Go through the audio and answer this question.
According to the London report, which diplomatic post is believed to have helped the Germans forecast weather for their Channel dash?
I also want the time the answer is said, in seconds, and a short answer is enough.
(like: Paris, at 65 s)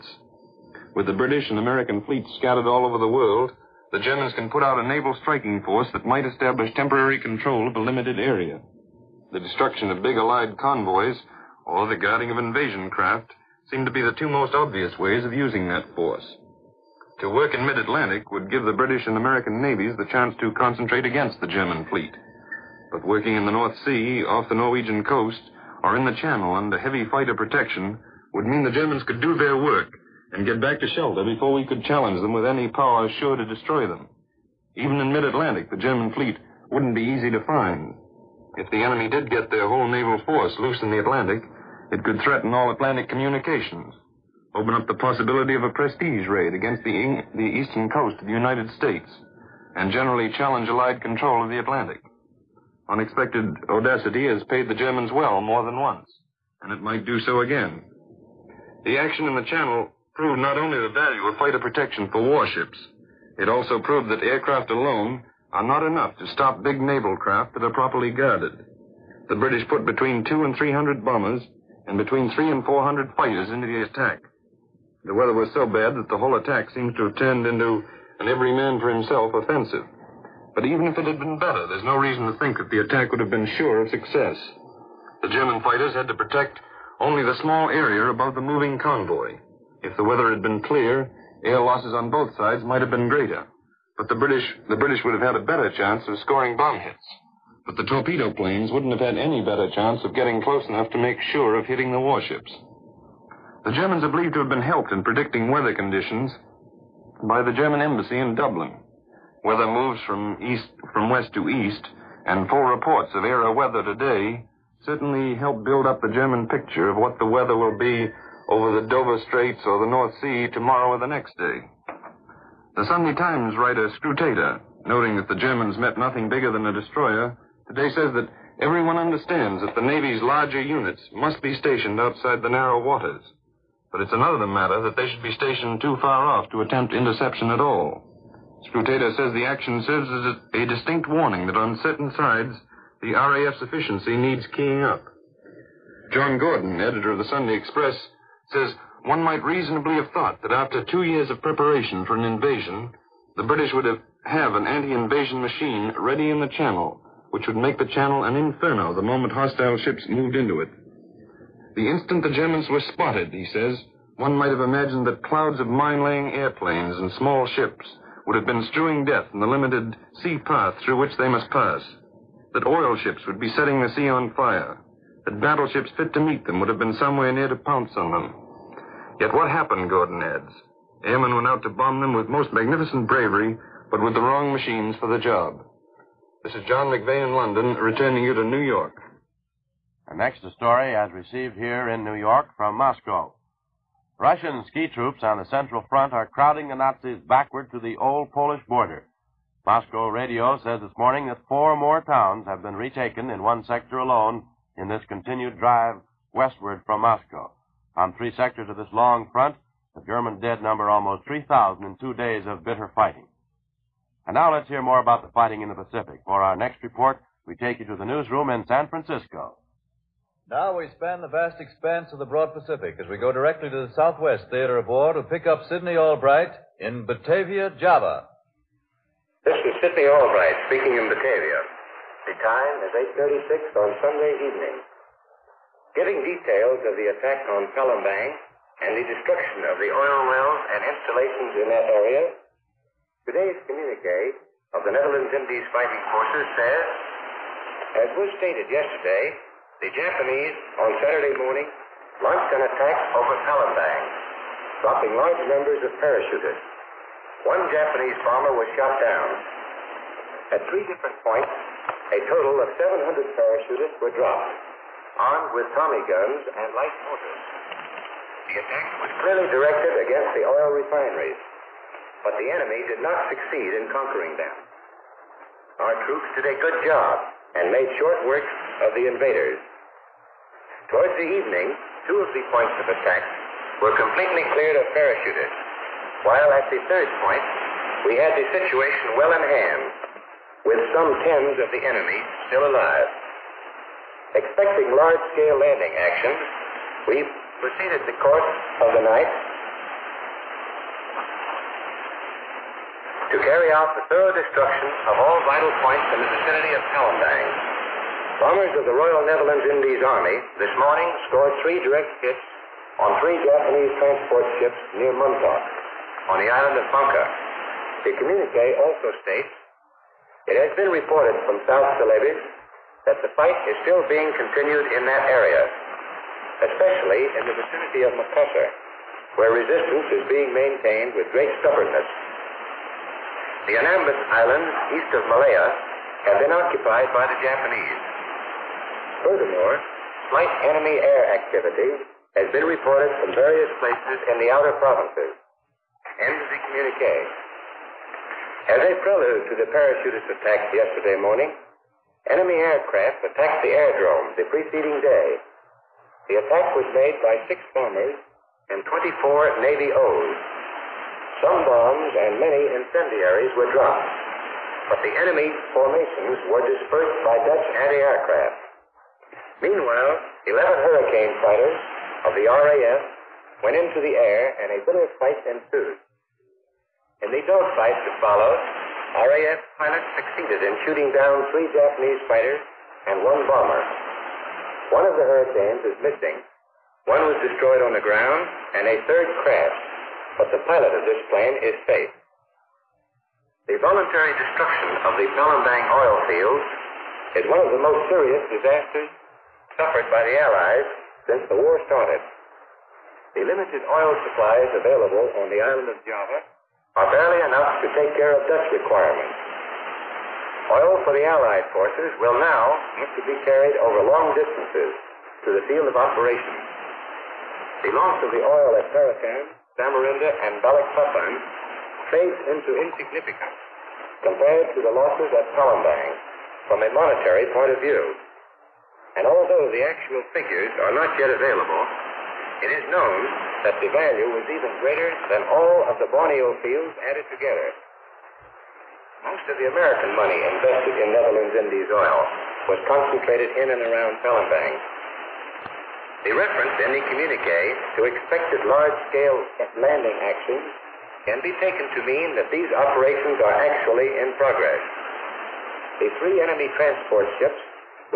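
German embassy in Dublin, at 107 s.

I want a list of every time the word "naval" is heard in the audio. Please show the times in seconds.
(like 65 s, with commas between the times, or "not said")
4 s, 39 s, 66 s.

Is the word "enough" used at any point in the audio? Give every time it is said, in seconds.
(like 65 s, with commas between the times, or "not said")
65 s, 100 s, 407 s.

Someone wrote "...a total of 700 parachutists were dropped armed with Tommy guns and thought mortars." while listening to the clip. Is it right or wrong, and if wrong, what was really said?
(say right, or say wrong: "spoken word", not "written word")
wrong: "light", not "thought".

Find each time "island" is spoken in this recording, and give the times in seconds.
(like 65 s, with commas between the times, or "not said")
316 s, 334 s, 405 s.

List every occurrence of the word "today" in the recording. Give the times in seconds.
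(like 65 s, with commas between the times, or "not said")
113 s, 127 s, 243 s.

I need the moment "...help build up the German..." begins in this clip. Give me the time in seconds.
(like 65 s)
115 s.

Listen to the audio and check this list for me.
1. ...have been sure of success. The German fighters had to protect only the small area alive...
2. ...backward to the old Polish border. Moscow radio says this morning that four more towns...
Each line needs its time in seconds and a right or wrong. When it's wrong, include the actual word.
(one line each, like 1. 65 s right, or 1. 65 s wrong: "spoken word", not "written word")
1. 83 s wrong: "above", not "alive"
2. 197 s right.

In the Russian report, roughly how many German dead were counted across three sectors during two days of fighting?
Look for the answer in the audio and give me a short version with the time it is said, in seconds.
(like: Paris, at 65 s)
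almost 3,000, at 210 s.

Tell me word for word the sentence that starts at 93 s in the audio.
But the British, the British would have had a better chance of scoring bomb hits.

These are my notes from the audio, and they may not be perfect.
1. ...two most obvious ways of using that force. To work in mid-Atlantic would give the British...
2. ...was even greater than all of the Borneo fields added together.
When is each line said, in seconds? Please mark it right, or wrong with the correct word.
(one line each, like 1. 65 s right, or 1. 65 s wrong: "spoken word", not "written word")
1. 14 s right
2. 434 s right.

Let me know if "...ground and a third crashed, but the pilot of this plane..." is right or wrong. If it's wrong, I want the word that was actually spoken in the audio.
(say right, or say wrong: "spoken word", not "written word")
right.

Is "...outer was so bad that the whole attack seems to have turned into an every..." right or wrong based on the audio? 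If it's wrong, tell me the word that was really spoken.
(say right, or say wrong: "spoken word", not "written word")
wrong: "weather", not "outer".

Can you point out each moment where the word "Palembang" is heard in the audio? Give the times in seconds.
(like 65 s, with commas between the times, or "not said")
237 s, 253 s, 306 s, 395 s, 425 s, 444 s.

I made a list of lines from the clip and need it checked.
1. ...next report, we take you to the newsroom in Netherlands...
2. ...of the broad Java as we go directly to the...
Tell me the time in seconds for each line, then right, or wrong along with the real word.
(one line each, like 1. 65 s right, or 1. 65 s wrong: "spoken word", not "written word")
1. 216 s wrong: "San", not "Netherlands"
2. 222 s wrong: "Pacific", not "Java".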